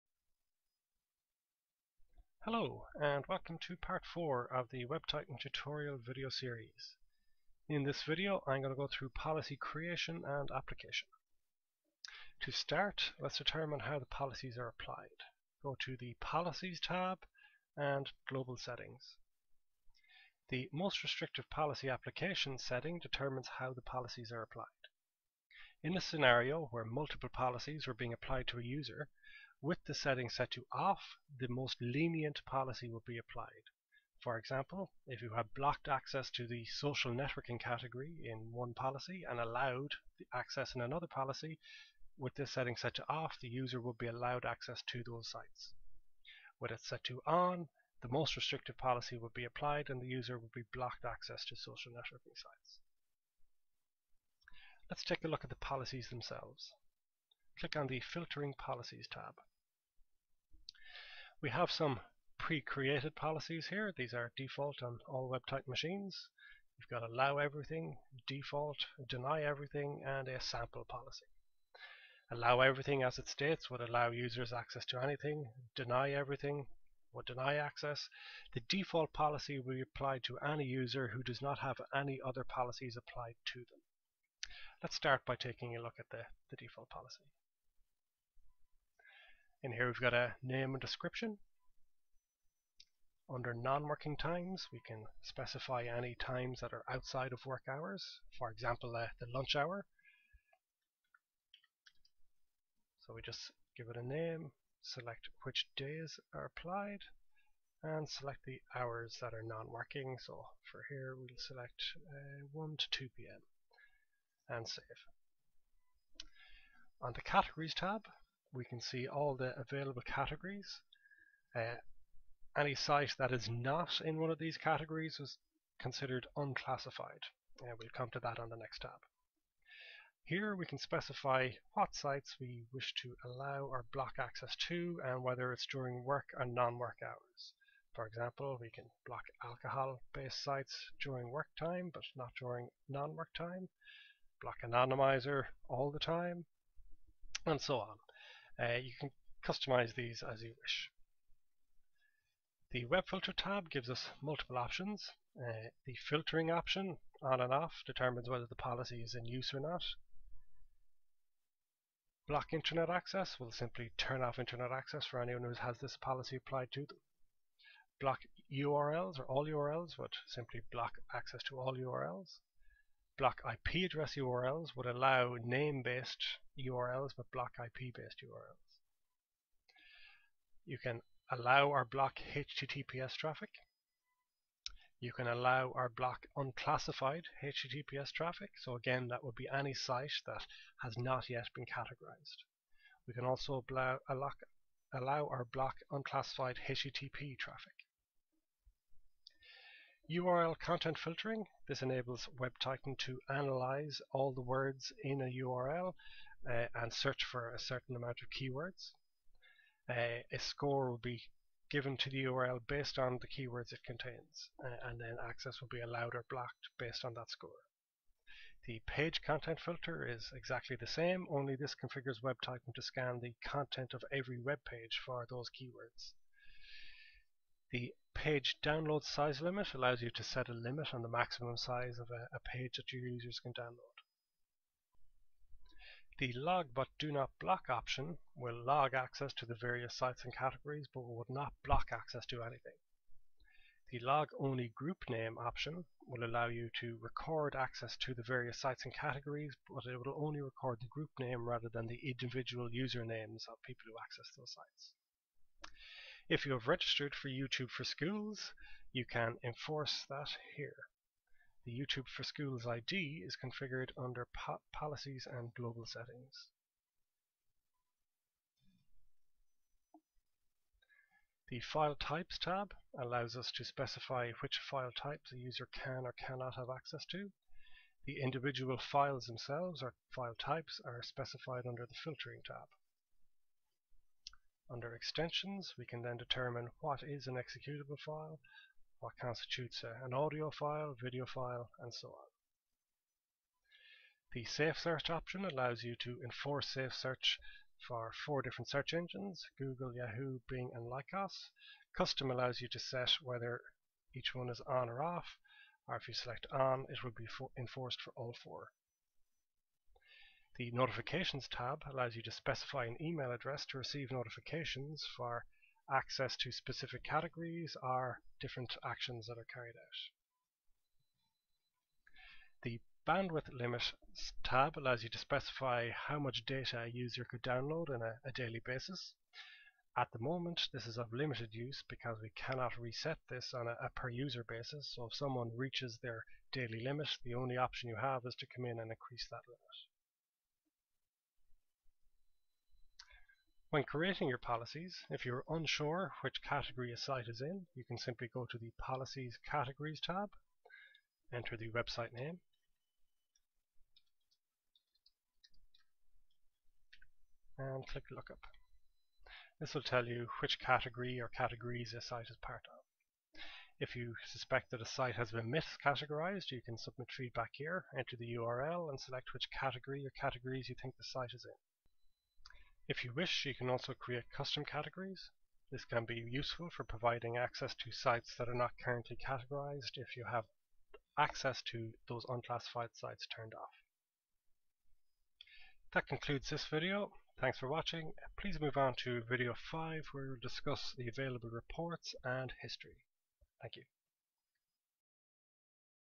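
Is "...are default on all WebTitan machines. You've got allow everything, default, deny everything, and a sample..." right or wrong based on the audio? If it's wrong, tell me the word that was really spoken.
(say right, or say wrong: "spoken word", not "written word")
right.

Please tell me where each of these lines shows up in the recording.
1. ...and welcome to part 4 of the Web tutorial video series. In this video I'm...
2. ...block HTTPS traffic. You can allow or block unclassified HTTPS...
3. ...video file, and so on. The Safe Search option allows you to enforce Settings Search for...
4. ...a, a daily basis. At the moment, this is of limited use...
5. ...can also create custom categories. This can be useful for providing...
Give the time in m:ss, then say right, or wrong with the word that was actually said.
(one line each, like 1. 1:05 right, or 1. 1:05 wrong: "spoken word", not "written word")
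1. 0:02 right
2. 3:01 right
3. 4:50 wrong: "Safe", not "Settings"
4. 5:28 right
5. 6:13 right.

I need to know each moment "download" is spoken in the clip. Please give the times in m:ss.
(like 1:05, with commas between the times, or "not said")
3:48, 3:53, 5:27.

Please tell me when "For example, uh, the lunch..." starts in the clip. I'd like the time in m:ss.
1:38.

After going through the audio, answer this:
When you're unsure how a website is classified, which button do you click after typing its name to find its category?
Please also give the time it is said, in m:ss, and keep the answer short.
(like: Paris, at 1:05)
Lookup, at 5:58.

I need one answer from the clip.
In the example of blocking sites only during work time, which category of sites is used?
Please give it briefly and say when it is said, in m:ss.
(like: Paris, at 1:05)
alcohol-based sites, at 2:19.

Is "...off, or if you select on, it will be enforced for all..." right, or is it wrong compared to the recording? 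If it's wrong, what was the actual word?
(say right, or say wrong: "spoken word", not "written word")
right.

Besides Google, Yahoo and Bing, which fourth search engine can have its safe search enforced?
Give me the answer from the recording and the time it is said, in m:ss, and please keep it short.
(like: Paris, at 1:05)
Lycos, at 5:00.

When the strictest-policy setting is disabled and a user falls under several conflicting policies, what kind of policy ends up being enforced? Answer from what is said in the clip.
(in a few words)
most lenient.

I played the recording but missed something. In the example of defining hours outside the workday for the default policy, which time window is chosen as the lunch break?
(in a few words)
1 to 2 p.m.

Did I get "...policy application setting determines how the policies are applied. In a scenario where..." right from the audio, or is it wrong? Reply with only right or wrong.
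right.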